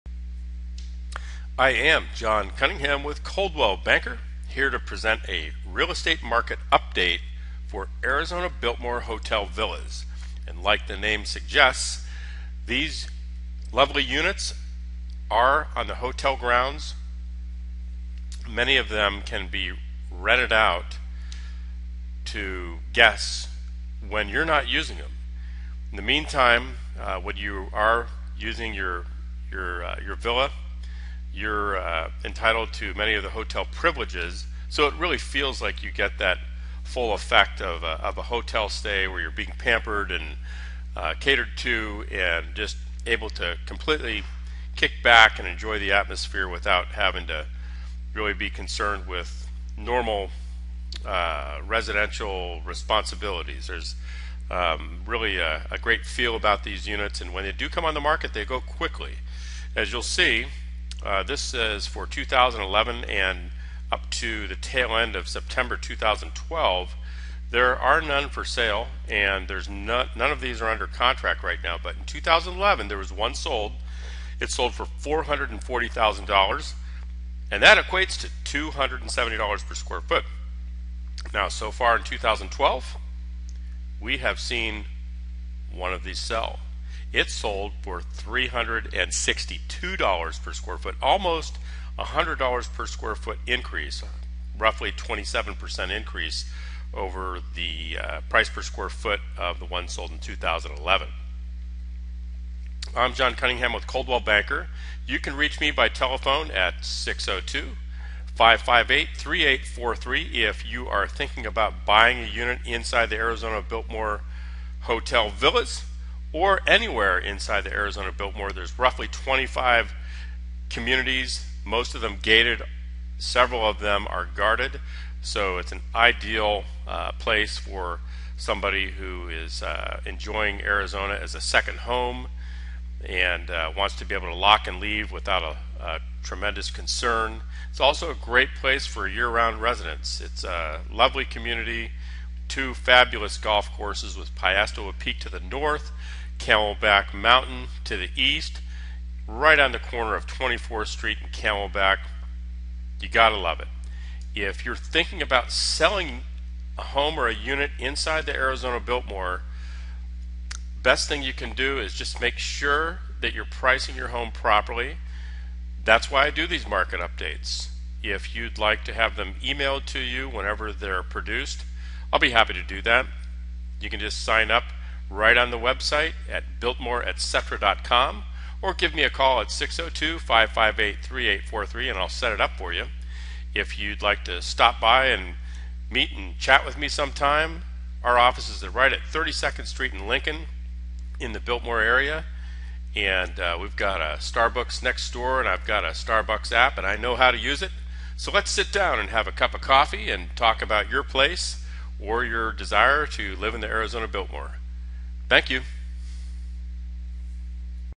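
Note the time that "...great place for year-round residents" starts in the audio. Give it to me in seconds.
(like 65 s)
138 s.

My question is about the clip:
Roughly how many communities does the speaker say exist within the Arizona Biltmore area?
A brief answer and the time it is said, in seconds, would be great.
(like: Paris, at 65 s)
25, at 119 s.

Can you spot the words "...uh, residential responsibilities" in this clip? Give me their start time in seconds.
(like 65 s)
51 s.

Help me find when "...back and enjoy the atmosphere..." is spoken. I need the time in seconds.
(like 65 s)
45 s.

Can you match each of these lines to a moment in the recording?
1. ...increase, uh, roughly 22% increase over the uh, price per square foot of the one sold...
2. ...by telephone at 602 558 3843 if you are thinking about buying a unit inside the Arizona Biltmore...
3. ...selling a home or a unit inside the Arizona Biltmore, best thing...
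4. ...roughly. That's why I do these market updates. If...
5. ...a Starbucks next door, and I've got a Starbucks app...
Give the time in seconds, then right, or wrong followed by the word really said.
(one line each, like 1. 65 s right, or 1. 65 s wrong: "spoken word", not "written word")
1. 93 s wrong: "27", not "22"
2. 105 s right
3. 155 s right
4. 164 s wrong: "properly", not "roughly"
5. 194 s right.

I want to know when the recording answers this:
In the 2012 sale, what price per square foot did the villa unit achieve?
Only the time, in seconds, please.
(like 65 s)
87 s.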